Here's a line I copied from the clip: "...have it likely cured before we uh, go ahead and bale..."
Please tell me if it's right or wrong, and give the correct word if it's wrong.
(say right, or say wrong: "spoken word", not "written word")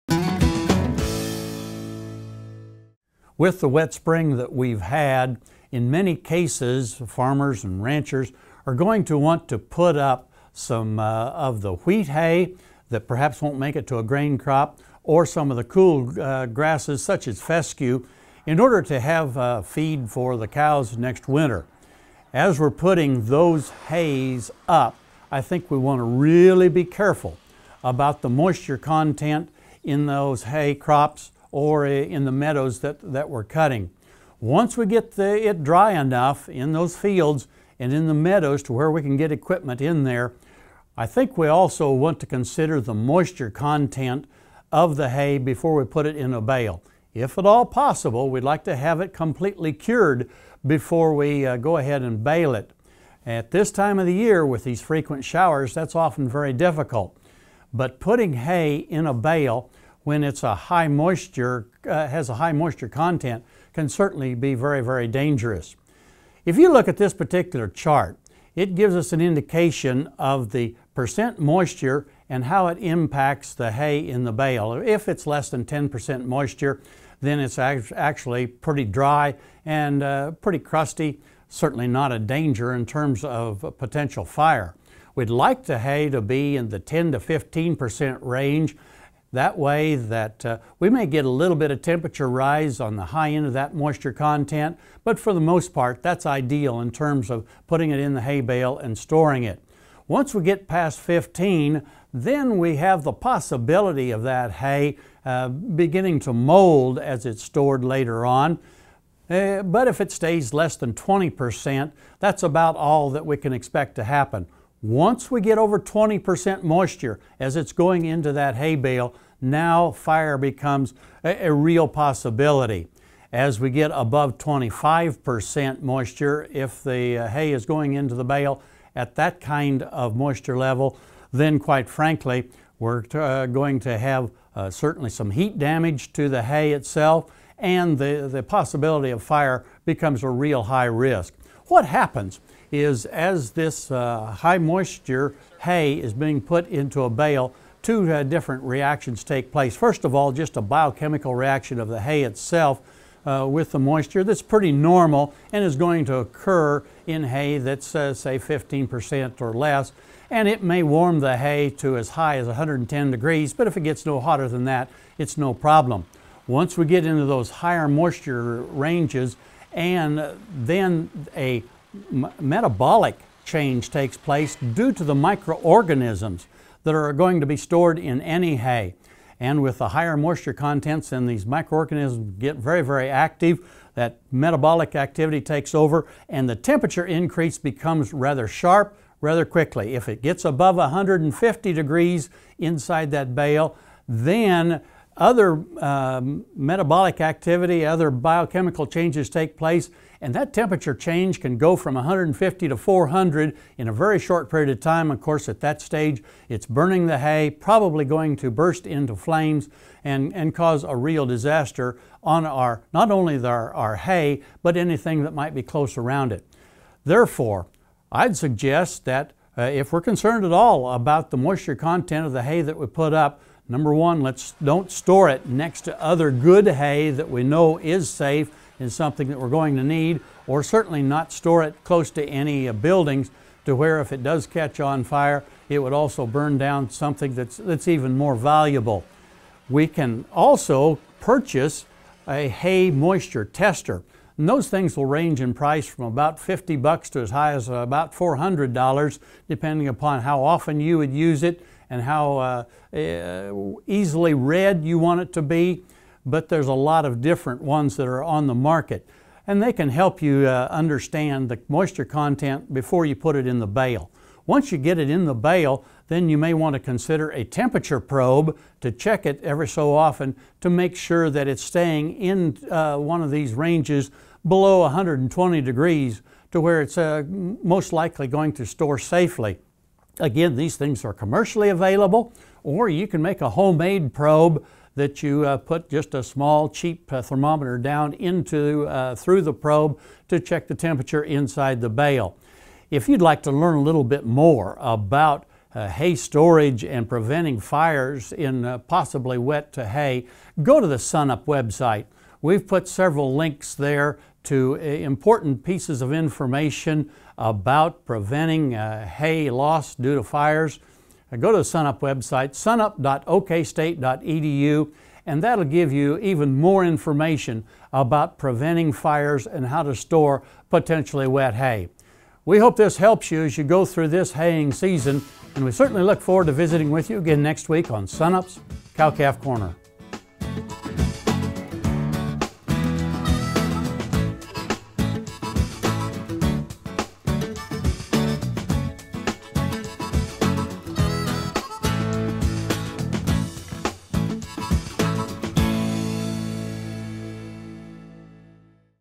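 wrong: "completely", not "likely".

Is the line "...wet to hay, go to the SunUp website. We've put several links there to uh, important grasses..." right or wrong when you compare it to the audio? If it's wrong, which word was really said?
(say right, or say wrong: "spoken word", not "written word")
wrong: "pieces", not "grasses".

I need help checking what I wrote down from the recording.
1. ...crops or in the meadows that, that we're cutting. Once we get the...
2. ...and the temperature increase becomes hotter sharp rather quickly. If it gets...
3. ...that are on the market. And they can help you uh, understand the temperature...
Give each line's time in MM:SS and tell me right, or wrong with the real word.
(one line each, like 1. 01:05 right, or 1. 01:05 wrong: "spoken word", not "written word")
1. 00:30 right
2. 03:06 wrong: "rather", not "hotter"
3. 04:17 wrong: "moisture", not "temperature".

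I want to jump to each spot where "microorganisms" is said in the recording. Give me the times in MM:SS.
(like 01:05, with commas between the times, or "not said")
02:55, 03:01.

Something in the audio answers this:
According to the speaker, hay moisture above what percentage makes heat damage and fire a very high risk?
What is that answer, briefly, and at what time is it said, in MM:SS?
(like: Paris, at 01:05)
25%, at 02:04.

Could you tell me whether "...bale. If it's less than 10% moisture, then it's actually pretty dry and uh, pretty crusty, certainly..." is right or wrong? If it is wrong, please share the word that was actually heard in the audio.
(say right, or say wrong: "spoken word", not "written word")
right.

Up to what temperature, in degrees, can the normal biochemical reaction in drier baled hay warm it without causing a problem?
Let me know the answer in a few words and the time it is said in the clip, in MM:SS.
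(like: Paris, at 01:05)
110 degrees, at 02:42.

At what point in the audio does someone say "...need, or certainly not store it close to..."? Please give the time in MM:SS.
03:49.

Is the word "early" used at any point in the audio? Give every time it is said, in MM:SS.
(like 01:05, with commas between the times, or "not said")
not said.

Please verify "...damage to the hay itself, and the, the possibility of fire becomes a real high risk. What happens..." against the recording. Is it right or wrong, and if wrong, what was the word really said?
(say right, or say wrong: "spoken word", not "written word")
right.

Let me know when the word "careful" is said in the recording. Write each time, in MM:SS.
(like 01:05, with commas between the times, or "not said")
00:26.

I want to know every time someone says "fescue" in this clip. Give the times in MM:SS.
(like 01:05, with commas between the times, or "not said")
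00:17.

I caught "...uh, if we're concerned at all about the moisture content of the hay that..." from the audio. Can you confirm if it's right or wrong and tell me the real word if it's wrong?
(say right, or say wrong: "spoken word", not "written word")
right.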